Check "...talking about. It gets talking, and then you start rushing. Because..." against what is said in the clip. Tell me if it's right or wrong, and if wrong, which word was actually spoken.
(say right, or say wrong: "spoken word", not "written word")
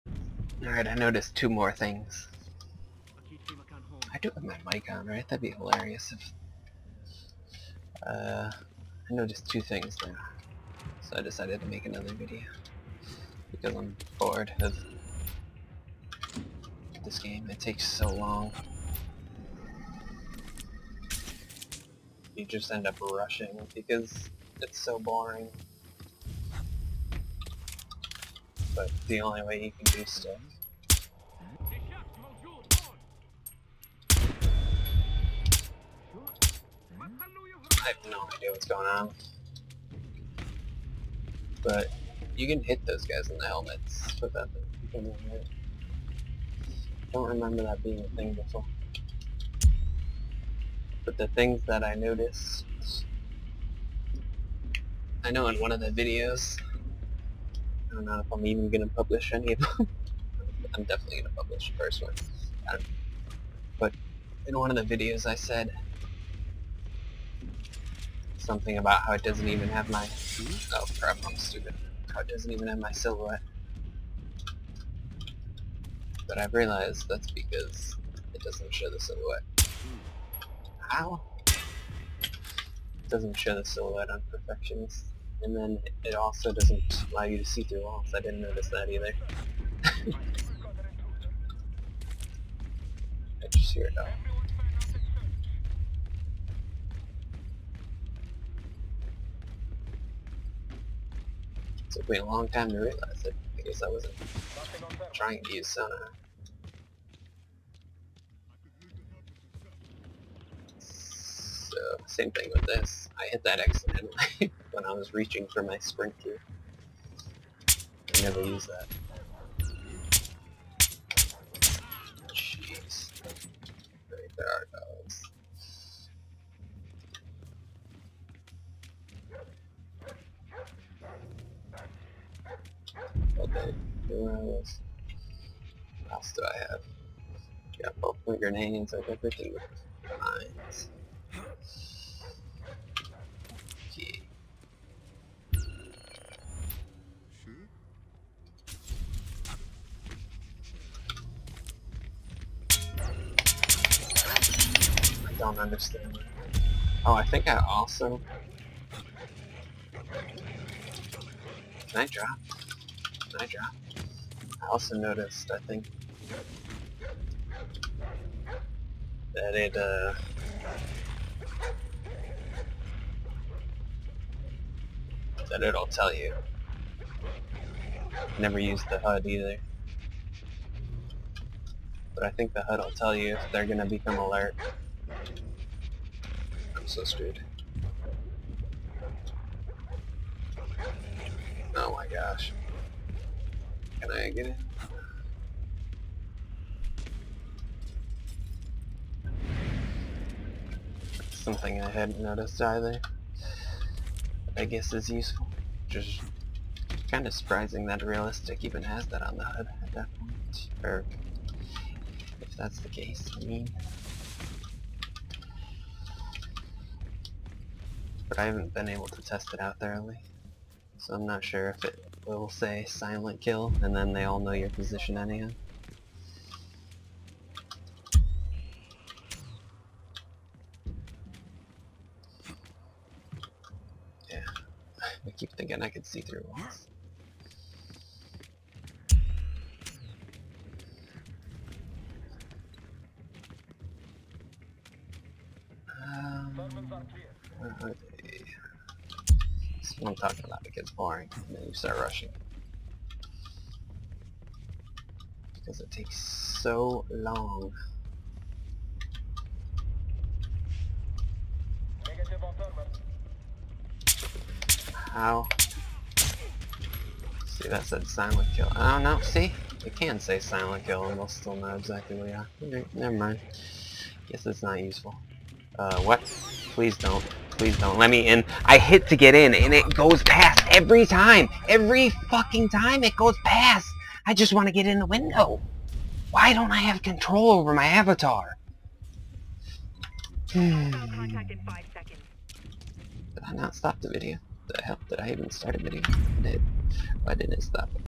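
wrong: "boring", not "talking".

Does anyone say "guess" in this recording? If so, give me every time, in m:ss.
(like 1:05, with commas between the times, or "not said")
3:24, 4:34.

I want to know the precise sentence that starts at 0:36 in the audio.
I have no idea what's going on.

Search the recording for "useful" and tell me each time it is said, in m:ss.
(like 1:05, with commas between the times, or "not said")
3:25, 4:34.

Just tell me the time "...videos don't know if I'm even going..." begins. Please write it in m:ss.
0:55.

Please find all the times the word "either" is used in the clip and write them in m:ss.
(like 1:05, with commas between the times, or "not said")
1:28, 2:59, 3:22.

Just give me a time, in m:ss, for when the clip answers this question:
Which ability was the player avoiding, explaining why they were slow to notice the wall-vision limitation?
1:45.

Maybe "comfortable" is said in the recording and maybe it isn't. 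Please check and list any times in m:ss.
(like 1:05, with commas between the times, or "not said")
not said.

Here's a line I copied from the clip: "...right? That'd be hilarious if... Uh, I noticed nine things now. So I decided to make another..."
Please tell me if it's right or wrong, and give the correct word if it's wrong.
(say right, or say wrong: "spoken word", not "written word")
wrong: "two", not "nine".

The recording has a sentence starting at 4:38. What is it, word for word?
I hit to get in and it goes past every time.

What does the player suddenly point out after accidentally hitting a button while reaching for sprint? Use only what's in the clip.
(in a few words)
dogs.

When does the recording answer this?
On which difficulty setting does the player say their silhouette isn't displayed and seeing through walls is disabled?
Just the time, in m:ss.
1:24.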